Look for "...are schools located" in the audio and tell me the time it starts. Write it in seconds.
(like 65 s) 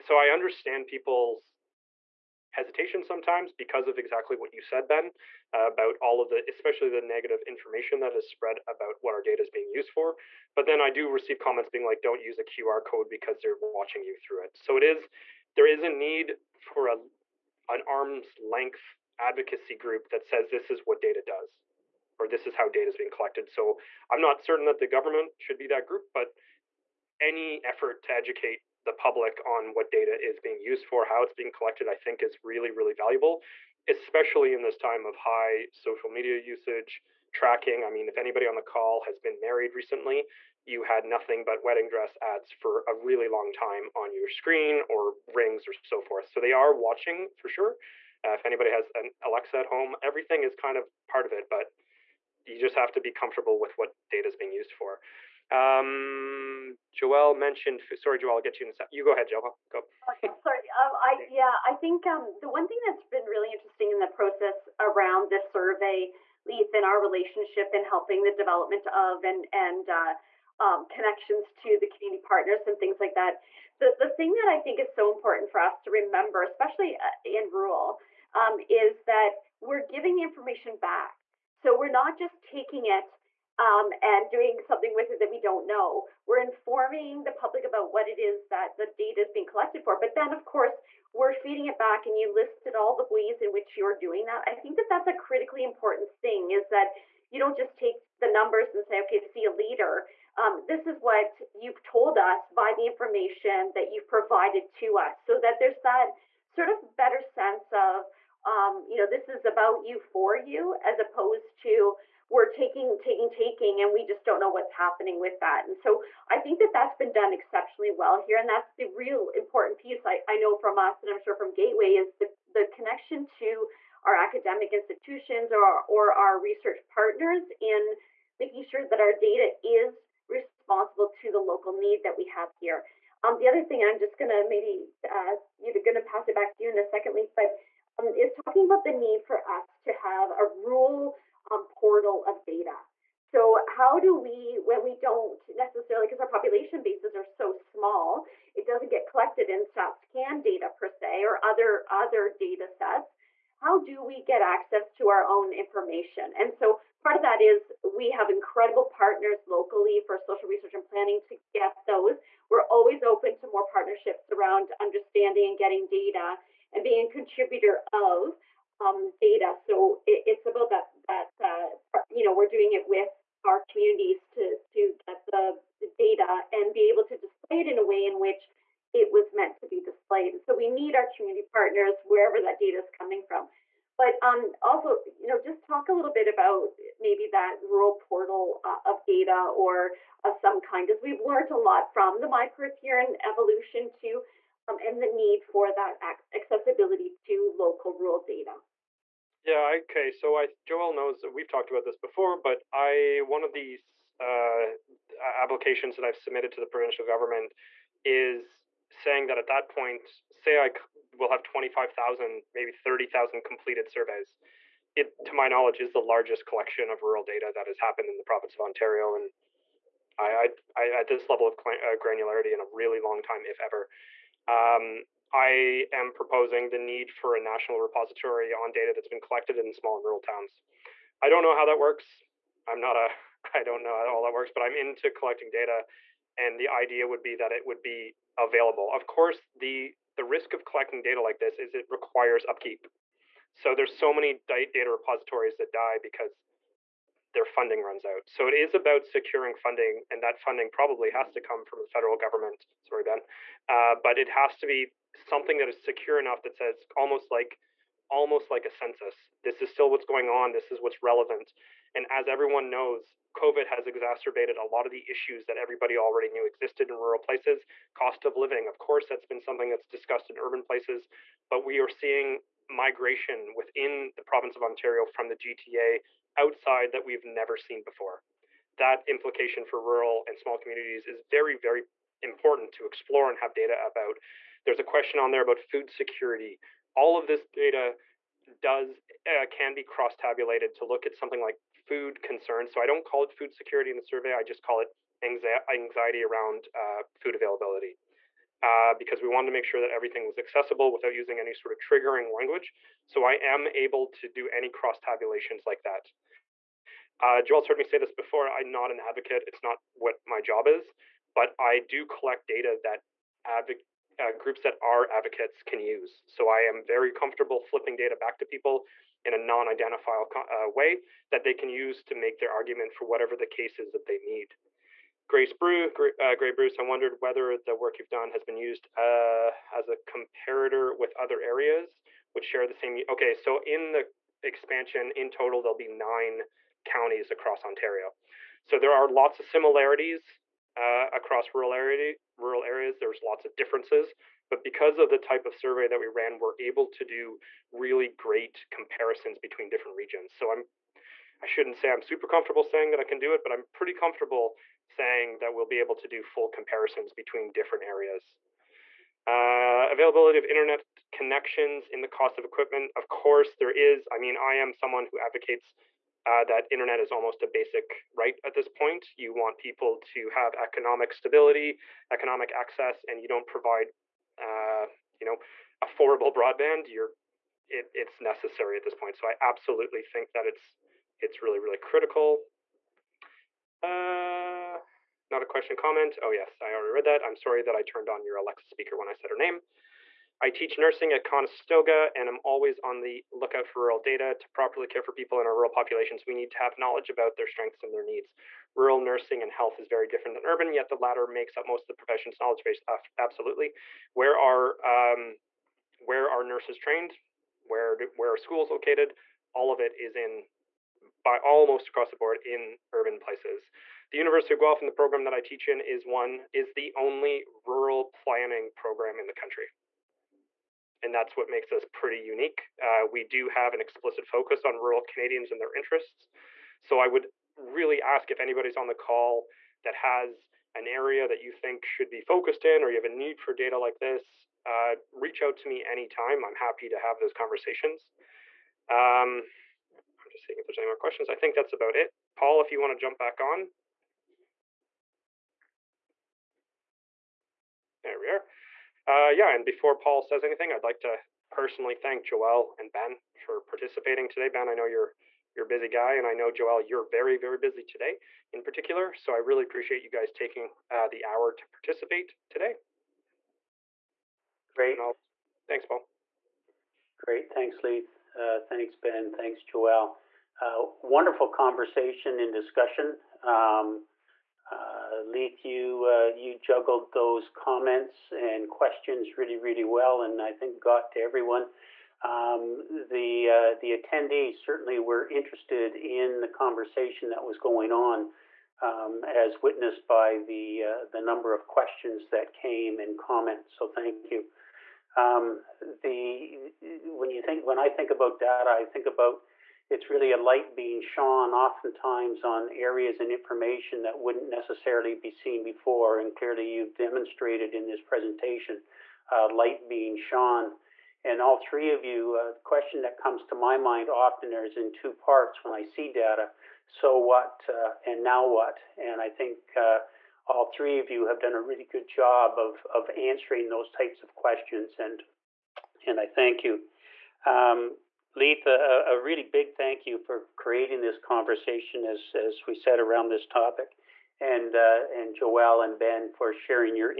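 408 s.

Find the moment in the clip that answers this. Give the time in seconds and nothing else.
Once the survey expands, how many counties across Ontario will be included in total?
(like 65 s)
335 s.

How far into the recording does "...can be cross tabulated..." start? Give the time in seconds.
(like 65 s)
289 s.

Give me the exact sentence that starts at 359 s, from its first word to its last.
Uh, availability of internet connections in the cost of equipment.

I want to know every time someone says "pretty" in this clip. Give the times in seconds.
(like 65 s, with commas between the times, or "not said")
353 s, 421 s.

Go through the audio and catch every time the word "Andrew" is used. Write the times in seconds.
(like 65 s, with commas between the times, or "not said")
not said.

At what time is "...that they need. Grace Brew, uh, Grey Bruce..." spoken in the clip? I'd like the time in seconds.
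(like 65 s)
323 s.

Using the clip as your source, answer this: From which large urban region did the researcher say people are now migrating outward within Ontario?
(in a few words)
GTA.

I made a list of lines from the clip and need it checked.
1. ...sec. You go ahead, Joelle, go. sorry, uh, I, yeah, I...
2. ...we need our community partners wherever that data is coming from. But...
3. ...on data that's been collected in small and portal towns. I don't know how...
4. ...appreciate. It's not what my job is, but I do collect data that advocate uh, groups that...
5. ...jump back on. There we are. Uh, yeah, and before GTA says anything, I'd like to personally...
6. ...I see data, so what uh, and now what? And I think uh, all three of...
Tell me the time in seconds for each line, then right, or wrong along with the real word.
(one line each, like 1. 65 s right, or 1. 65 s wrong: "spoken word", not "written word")
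1. 58 s right
2. 180 s right
3. 228 s wrong: "rural", not "portal"
4. 309 s wrong: "advocate", not "appreciate"
5. 442 s wrong: "Paul", not "GTA"
6. 515 s right.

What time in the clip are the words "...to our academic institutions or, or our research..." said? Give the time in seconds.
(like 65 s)
123 s.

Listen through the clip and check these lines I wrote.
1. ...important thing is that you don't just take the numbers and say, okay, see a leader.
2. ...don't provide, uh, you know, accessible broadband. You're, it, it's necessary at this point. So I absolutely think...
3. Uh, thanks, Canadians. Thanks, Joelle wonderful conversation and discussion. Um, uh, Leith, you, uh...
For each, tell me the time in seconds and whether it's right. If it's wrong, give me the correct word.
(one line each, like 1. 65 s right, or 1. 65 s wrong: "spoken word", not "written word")
1. 95 s right
2. 373 s wrong: "affordable", not "accessible"
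3. 468 s wrong: "Ben", not "Canadians".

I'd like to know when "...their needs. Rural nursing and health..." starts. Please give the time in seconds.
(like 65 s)
397 s.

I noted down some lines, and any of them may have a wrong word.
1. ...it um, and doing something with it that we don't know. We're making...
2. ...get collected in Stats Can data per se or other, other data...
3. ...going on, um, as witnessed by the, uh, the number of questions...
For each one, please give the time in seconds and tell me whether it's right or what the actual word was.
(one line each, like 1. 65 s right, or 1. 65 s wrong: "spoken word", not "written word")
1. 82 s wrong: "informing", not "making"
2. 148 s right
3. 487 s right.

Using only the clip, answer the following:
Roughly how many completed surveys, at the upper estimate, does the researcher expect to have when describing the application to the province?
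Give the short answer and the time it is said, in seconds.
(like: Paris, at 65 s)
30,000, at 212 s.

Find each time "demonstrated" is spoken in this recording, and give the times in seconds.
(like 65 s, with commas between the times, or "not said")
506 s.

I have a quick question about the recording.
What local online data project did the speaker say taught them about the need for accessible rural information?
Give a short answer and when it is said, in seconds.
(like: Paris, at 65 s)
My Perth, at 192 s.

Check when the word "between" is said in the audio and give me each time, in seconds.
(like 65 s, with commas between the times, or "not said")
349 s, 357 s.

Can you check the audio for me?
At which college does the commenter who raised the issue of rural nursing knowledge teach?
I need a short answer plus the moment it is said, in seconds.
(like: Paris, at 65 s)
Conestoga, at 391 s.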